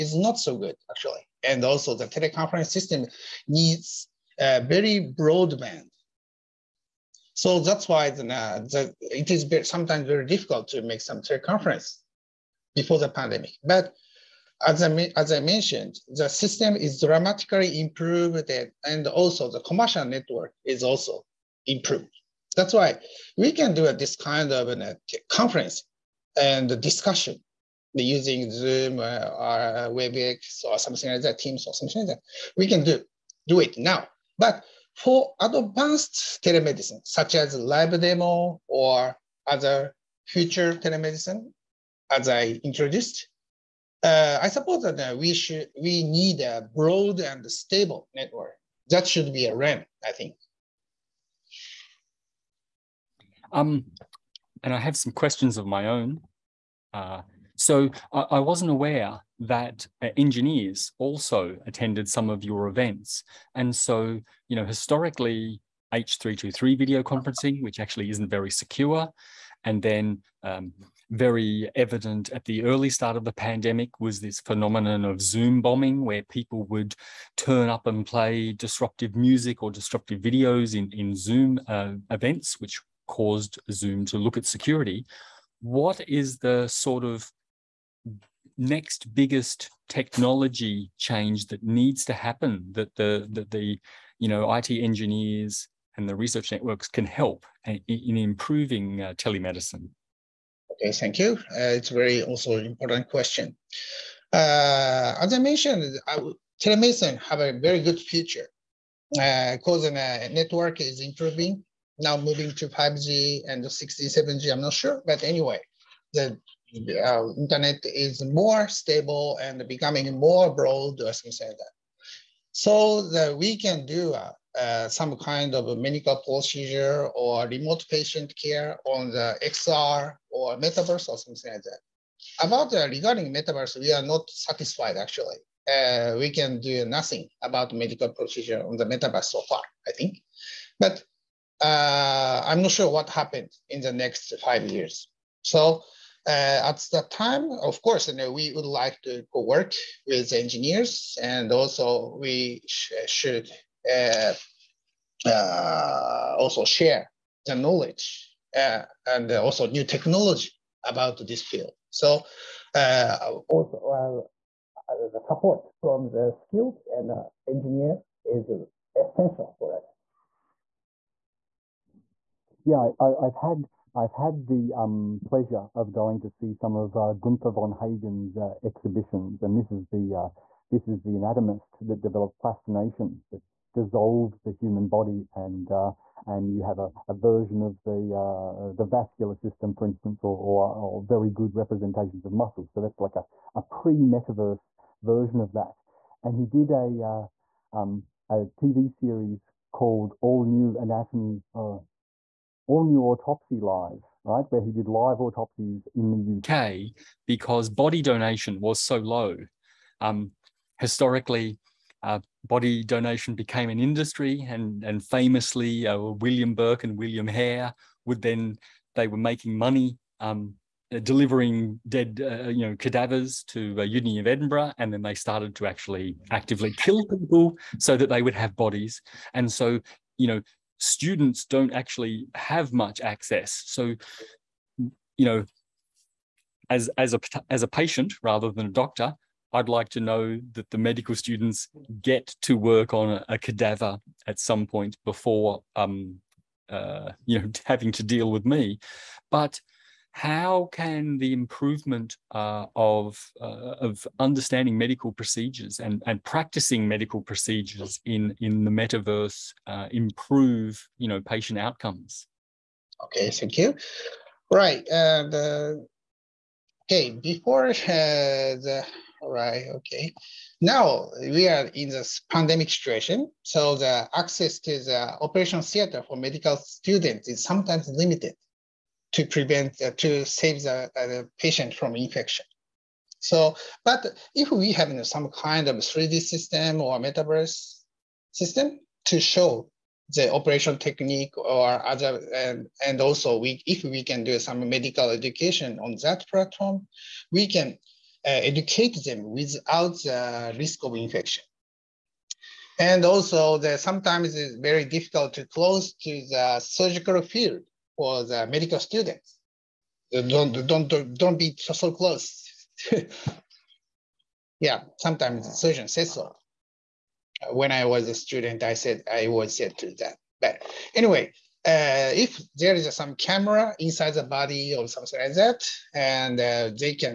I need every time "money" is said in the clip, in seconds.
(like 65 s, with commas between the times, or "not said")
219 s.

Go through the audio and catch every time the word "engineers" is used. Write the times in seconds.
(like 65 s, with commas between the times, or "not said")
60 s, 94 s, 150 s, 167 s.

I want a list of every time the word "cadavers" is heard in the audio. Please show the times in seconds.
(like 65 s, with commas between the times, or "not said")
222 s, 243 s.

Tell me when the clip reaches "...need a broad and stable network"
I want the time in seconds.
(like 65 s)
46 s.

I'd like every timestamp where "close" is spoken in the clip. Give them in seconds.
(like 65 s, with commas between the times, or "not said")
305 s, 311 s.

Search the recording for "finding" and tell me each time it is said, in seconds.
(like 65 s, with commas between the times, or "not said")
not said.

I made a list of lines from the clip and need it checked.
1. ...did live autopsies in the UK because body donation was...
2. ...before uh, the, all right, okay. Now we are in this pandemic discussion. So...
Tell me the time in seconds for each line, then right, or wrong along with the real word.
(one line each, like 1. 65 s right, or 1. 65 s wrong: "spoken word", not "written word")
1. 204 s right
2. 267 s wrong: "situation", not "discussion".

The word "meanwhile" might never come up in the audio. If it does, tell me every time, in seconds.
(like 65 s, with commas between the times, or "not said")
not said.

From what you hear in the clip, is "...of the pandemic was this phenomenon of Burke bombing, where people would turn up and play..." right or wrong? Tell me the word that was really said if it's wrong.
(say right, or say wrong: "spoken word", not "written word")
wrong: "Zoom", not "Burke".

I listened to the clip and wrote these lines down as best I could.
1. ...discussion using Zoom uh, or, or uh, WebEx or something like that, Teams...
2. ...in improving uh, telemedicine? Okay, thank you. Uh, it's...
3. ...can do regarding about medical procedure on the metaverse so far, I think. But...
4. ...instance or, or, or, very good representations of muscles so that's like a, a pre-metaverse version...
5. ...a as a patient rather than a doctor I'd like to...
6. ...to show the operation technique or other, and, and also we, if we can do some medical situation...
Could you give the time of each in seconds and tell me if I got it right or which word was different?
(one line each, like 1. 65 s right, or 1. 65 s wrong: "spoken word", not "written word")
1. 26 s right
2. 97 s right
3. 136 s wrong: "nothing", not "regarding"
4. 189 s right
5. 237 s right
6. 289 s wrong: "education", not "situation".